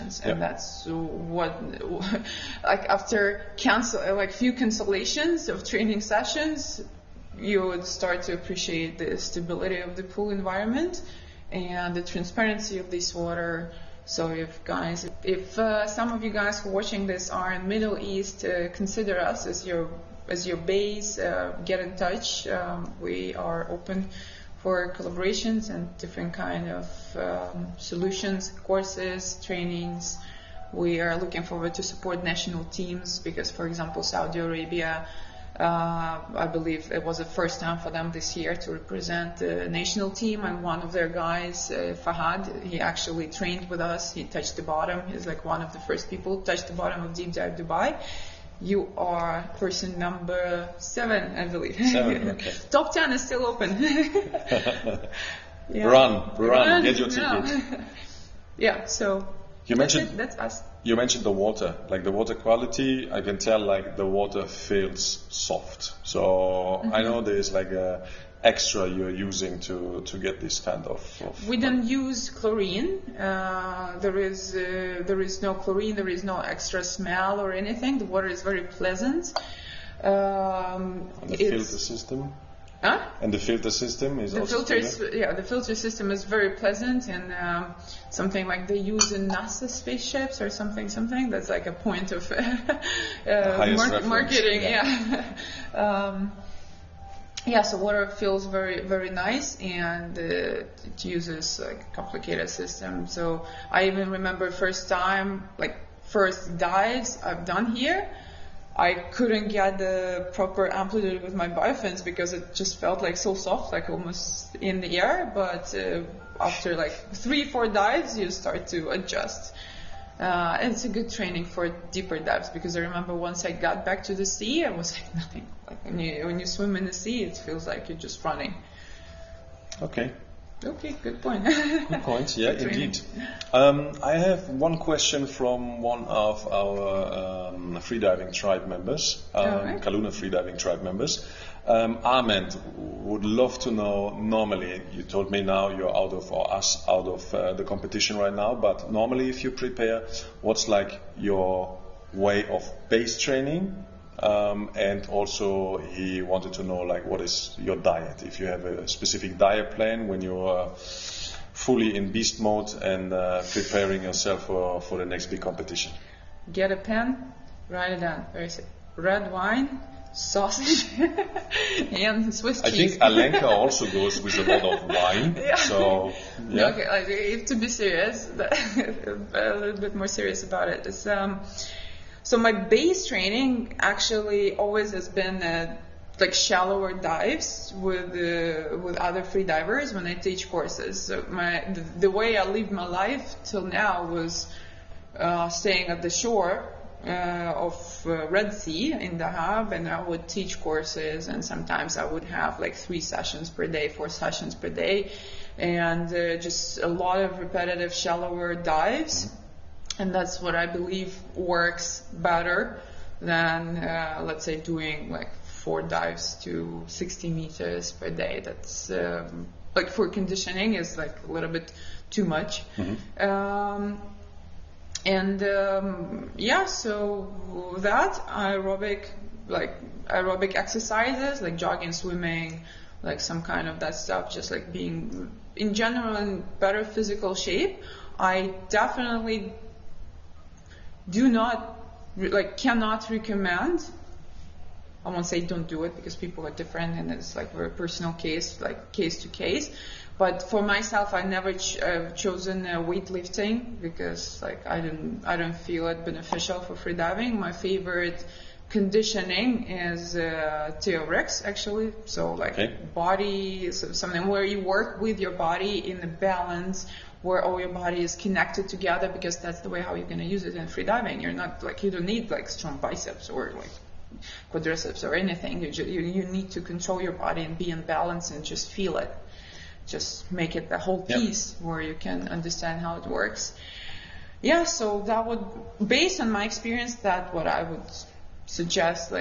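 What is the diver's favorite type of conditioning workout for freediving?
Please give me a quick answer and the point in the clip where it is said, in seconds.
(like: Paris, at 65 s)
TRX, at 260 s.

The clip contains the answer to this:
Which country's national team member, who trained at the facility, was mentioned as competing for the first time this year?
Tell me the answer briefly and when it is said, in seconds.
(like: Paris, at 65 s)
Saudi Arabia, at 34 s.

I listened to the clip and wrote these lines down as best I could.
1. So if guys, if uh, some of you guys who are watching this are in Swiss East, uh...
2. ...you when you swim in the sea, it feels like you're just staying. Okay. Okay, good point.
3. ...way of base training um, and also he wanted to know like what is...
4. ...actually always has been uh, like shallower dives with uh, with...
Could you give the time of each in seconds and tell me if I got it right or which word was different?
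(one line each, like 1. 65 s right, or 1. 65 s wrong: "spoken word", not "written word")
1. 14 s wrong: "Middle", not "Swiss"
2. 125 s wrong: "running", not "staying"
3. 152 s right
4. 183 s right.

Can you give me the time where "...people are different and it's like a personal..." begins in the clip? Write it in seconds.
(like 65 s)
246 s.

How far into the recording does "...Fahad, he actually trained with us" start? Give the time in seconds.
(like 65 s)
42 s.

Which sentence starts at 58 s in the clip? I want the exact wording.
yeah, so you that's mentioned it, that's us.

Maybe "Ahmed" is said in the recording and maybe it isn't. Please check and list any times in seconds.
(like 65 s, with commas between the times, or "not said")
142 s.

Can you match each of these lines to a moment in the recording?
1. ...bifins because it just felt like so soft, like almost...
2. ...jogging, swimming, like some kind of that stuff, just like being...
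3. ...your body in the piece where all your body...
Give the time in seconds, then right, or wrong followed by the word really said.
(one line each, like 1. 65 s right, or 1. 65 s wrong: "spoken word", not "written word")
1. 111 s right
2. 231 s right
3. 265 s wrong: "balance", not "piece".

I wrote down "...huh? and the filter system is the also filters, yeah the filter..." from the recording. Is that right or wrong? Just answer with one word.
right.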